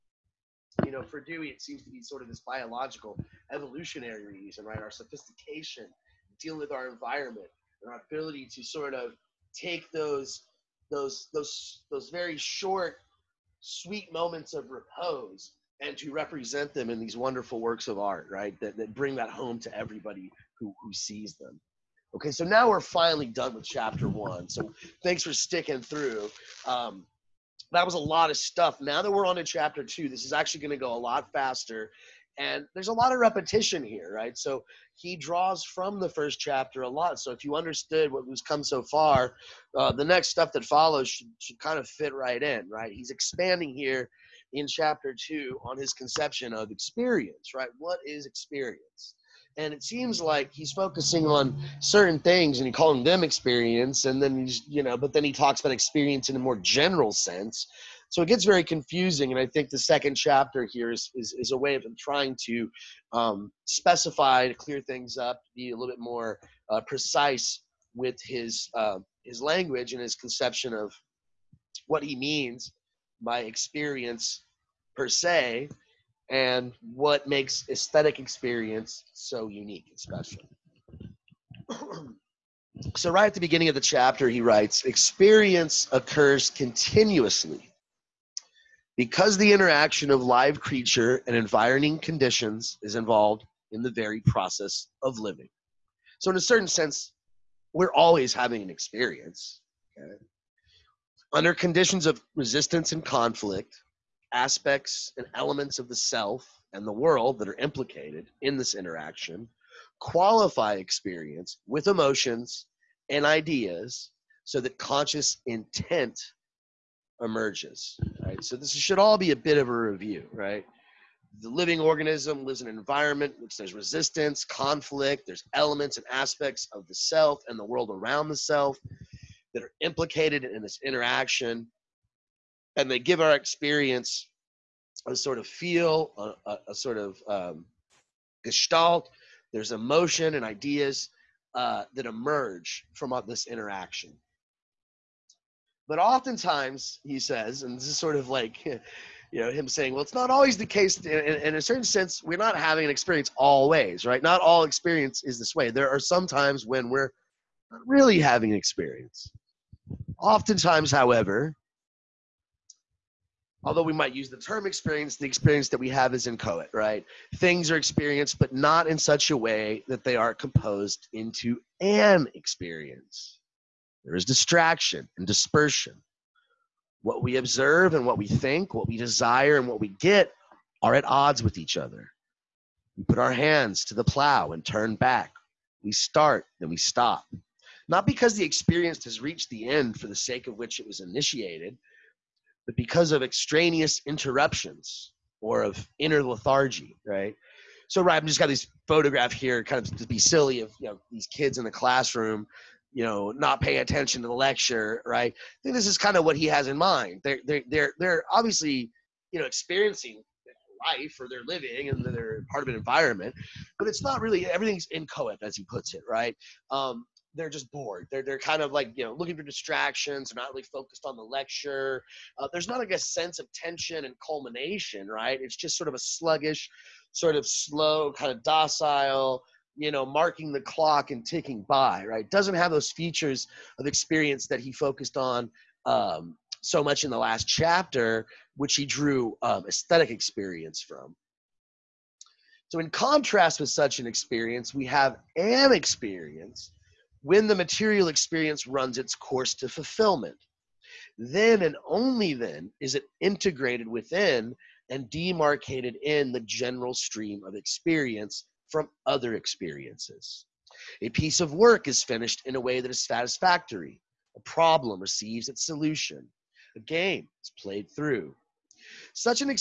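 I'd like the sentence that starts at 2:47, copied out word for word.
Things are experienced, but not in such a way that they are composed into an experience.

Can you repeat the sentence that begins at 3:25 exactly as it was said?
I think this is kind of what he has in mind.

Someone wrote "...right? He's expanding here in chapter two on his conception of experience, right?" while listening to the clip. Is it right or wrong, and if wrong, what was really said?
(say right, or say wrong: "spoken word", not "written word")
right.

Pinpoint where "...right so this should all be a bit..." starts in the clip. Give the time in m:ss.
1:58.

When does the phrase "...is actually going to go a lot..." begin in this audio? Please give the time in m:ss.
0:30.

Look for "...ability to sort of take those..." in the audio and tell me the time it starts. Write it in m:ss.
0:08.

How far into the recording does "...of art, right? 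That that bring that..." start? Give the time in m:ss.
0:17.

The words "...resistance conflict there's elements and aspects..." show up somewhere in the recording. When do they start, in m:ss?
2:03.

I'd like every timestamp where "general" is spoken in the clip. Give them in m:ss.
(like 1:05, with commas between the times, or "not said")
0:56, 4:16.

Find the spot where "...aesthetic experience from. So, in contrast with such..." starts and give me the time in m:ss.
3:59.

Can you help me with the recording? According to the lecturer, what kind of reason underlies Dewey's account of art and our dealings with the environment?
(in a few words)
biological, evolutionary.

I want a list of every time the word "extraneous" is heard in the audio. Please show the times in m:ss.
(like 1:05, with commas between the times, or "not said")
3:13.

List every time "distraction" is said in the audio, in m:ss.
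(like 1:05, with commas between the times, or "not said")
2:54, 3:39.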